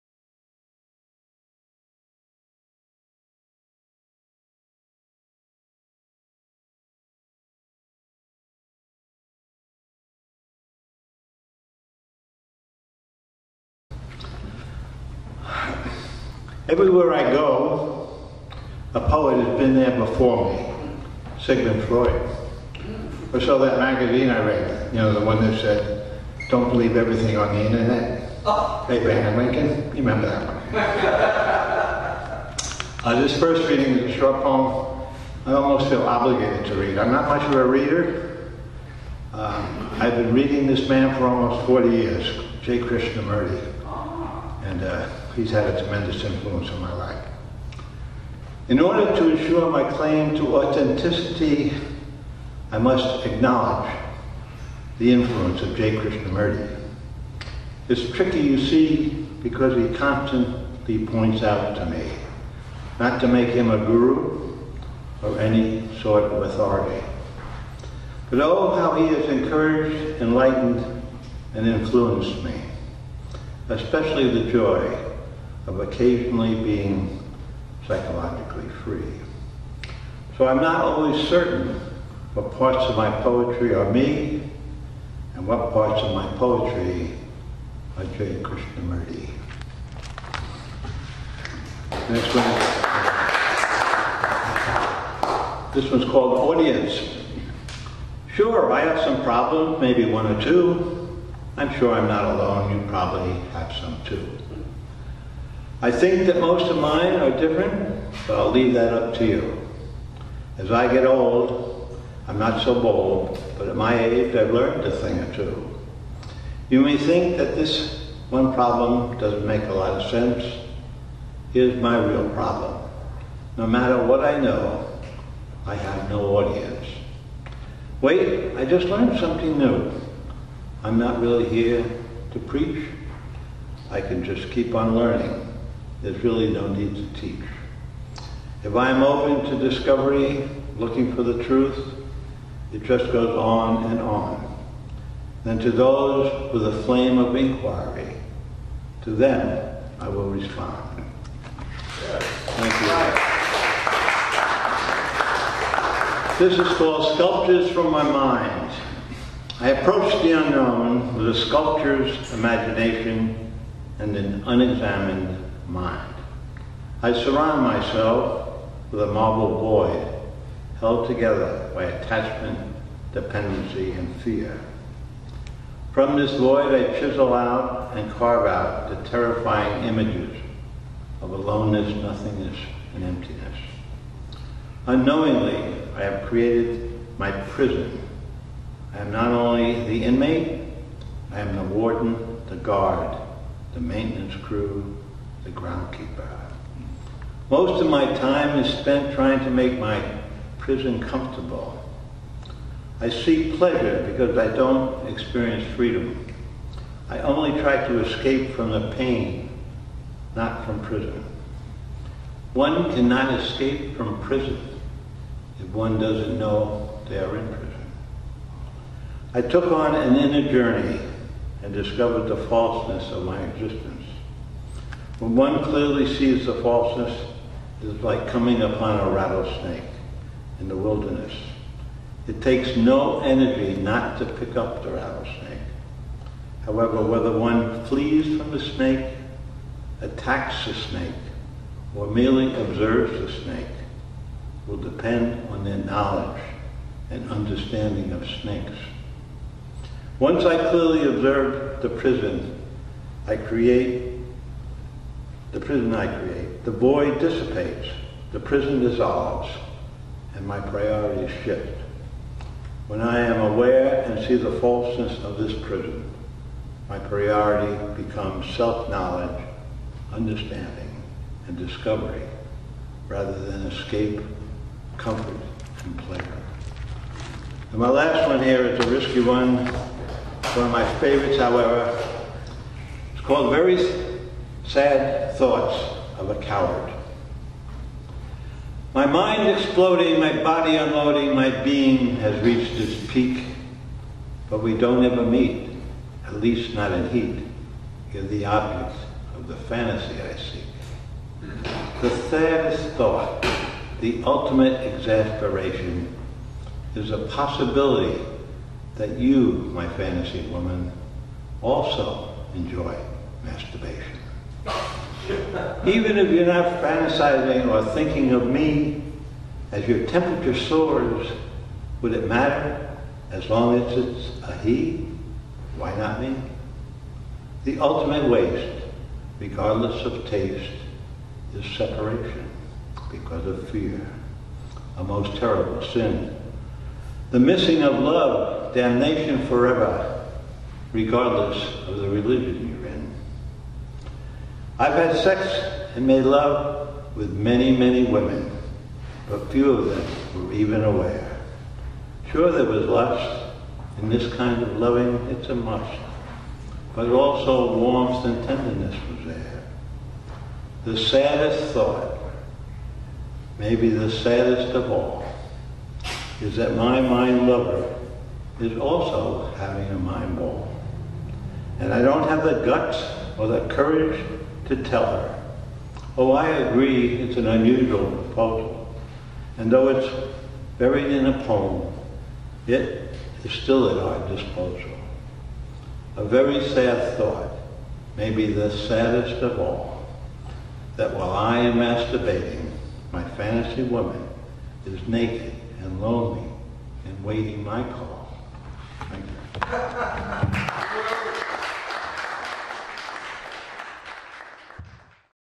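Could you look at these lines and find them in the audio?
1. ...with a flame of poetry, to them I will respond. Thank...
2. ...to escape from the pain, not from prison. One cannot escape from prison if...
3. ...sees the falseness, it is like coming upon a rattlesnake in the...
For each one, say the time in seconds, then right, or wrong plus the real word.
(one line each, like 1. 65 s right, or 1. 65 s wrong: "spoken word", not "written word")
1. 146 s wrong: "inquiry", not "poetry"
2. 207 s right
3. 226 s right.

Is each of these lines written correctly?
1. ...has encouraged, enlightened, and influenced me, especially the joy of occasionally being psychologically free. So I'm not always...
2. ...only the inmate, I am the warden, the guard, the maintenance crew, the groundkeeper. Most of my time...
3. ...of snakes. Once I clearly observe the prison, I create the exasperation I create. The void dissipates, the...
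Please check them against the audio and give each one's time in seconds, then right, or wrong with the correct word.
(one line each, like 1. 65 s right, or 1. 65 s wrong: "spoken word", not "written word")
1. 69 s right
2. 189 s right
3. 248 s wrong: "prison", not "exasperation".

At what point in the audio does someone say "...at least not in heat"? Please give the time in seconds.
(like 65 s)
296 s.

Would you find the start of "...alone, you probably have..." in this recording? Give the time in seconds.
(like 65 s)
102 s.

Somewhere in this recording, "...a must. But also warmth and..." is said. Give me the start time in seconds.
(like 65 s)
355 s.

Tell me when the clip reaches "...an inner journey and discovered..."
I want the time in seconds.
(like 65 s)
219 s.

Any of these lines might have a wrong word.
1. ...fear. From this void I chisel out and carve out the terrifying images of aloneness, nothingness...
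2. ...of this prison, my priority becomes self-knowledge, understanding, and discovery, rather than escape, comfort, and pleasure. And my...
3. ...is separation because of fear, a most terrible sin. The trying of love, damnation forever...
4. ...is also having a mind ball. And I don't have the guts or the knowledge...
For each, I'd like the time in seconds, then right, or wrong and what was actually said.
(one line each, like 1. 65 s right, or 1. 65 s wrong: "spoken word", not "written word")
1. 174 s right
2. 265 s right
3. 331 s wrong: "missing", not "trying"
4. 368 s wrong: "courage", not "knowledge".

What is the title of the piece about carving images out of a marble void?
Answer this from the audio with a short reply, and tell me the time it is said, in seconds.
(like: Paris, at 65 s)
Sculptures from My Mind, at 157 s.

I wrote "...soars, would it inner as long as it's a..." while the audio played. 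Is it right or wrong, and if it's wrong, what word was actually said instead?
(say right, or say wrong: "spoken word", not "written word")
wrong: "matter", not "inner".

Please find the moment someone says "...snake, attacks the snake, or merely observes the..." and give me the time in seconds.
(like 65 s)
238 s.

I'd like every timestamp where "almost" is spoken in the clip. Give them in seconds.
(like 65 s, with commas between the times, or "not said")
35 s, 41 s.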